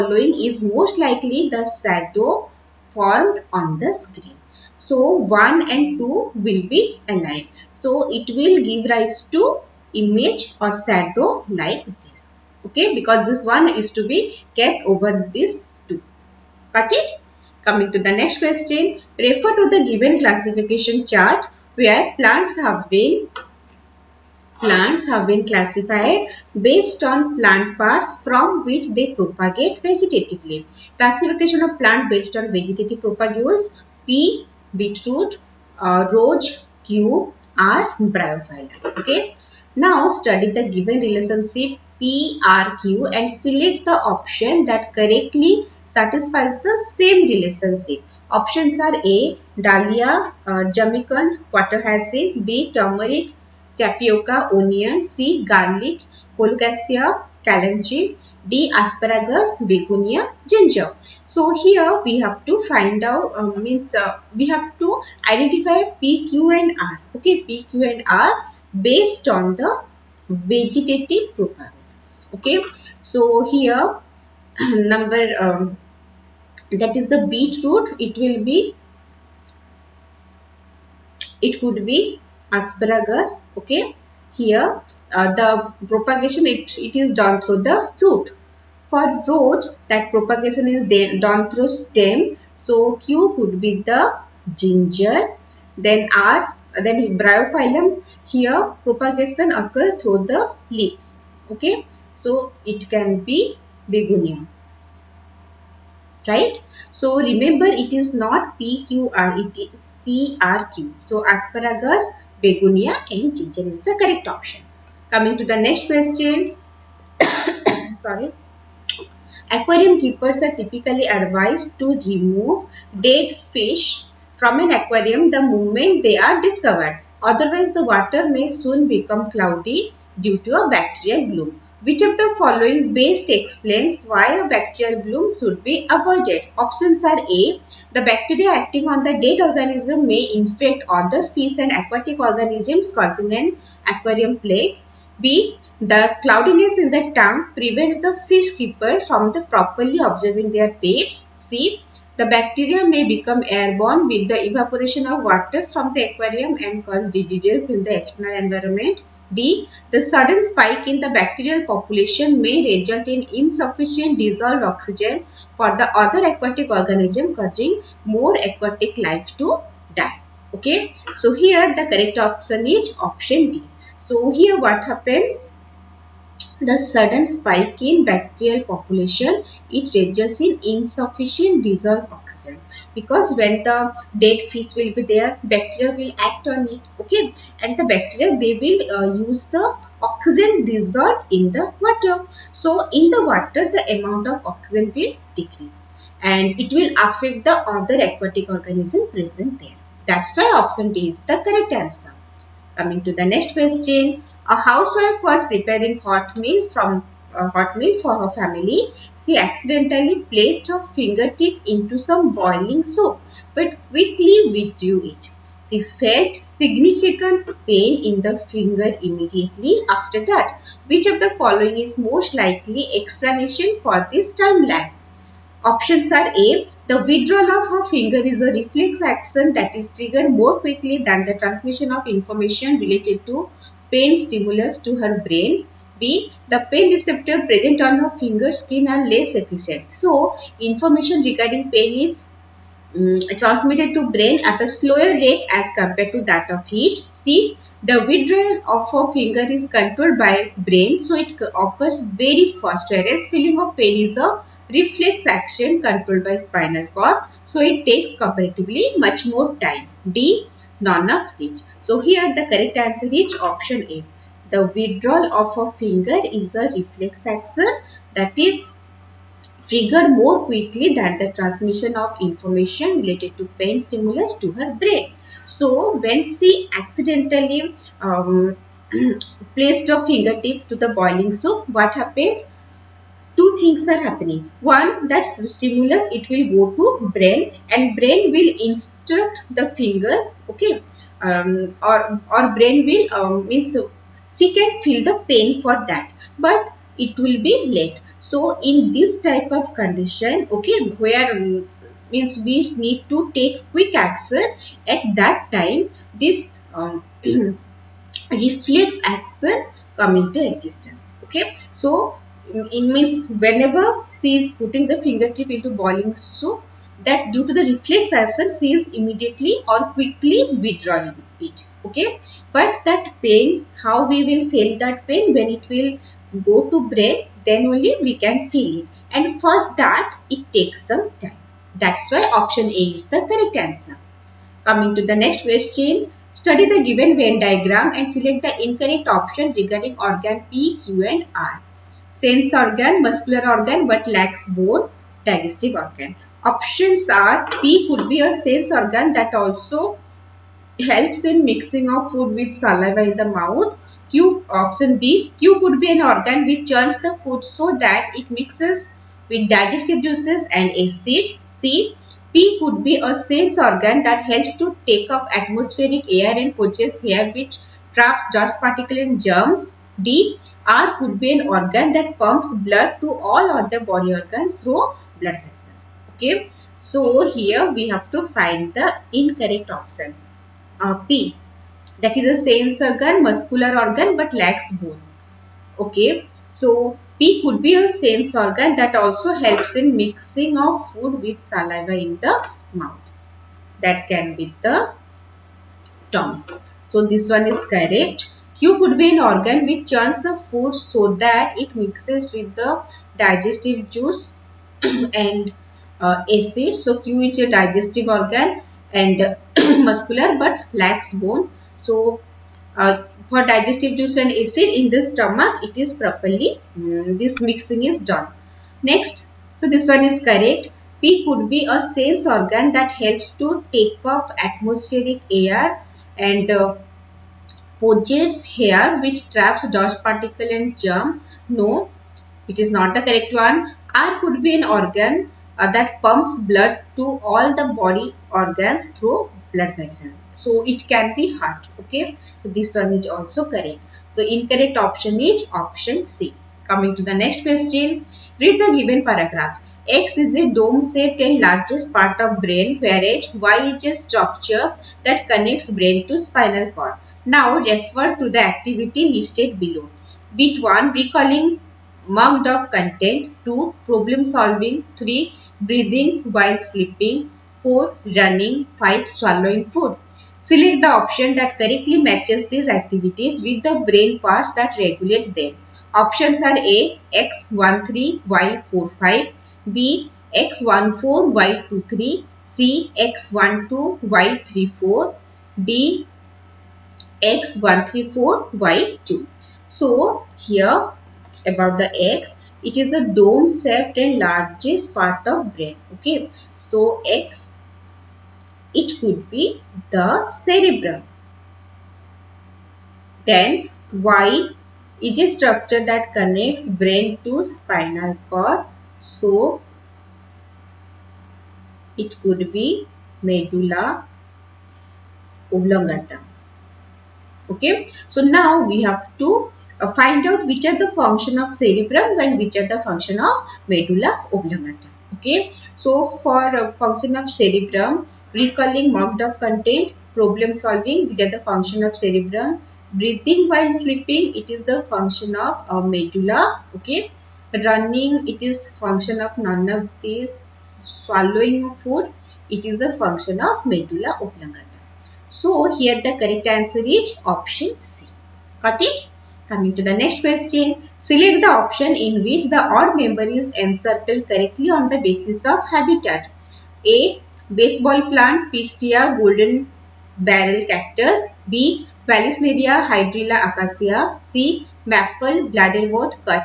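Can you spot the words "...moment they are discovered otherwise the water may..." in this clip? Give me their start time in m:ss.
2:05.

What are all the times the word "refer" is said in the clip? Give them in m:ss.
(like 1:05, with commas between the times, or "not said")
0:19, 7:37.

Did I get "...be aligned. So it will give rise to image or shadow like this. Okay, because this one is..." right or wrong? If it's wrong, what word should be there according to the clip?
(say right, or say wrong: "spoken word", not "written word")
right.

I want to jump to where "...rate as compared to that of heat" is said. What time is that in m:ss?
4:05.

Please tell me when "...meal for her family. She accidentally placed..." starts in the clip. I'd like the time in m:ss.
3:27.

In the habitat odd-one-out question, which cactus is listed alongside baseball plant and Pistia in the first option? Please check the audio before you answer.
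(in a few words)
Golden barrel cactus.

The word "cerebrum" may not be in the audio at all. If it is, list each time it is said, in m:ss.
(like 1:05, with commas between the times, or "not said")
8:20, 8:41, 8:47, 8:52.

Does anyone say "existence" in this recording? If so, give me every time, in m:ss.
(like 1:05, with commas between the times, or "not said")
5:10.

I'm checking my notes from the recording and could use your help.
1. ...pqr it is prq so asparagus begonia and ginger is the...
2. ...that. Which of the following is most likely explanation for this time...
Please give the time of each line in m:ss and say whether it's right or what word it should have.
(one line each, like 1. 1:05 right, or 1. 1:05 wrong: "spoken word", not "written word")
1. 1:48 right
2. 3:40 right.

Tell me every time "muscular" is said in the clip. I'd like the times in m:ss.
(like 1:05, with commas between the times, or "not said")
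5:43, 6:23, 6:49.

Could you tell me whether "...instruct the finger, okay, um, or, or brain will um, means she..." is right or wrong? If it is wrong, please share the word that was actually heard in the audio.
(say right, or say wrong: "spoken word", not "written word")
right.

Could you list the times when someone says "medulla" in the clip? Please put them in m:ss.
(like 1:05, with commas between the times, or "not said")
8:33, 8:43, 8:55, 9:03.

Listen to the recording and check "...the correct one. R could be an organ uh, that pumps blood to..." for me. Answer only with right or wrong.
right.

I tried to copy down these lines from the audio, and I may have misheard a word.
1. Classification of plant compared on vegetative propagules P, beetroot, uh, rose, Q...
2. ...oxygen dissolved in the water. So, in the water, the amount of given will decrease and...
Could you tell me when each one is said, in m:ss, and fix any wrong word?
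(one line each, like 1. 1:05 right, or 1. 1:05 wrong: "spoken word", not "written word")
1. 0:30 wrong: "based", not "compared"
2. 3:10 wrong: "oxygen", not "given".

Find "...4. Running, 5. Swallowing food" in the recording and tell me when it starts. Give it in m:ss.
7:47.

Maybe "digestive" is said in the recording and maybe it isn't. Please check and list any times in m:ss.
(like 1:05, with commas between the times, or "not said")
5:45, 5:59, 6:43, 6:47, 6:53.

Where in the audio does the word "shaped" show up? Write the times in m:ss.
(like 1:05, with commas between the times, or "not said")
7:30, 8:13.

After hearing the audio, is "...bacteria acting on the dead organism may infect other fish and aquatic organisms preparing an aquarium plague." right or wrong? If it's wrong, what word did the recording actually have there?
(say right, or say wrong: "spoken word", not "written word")
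wrong: "causing", not "preparing".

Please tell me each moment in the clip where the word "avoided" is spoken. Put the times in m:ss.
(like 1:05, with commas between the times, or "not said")
2:15.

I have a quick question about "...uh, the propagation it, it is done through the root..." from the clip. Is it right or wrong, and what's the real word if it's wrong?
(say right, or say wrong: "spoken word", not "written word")
right.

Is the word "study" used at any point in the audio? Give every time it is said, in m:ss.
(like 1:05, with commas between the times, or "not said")
0:40, 5:36.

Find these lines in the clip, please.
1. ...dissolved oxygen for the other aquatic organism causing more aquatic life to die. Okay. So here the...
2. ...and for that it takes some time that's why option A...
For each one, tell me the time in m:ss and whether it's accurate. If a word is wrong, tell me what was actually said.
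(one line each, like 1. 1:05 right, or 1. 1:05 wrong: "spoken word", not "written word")
1. 2:44 right
2. 5:29 right.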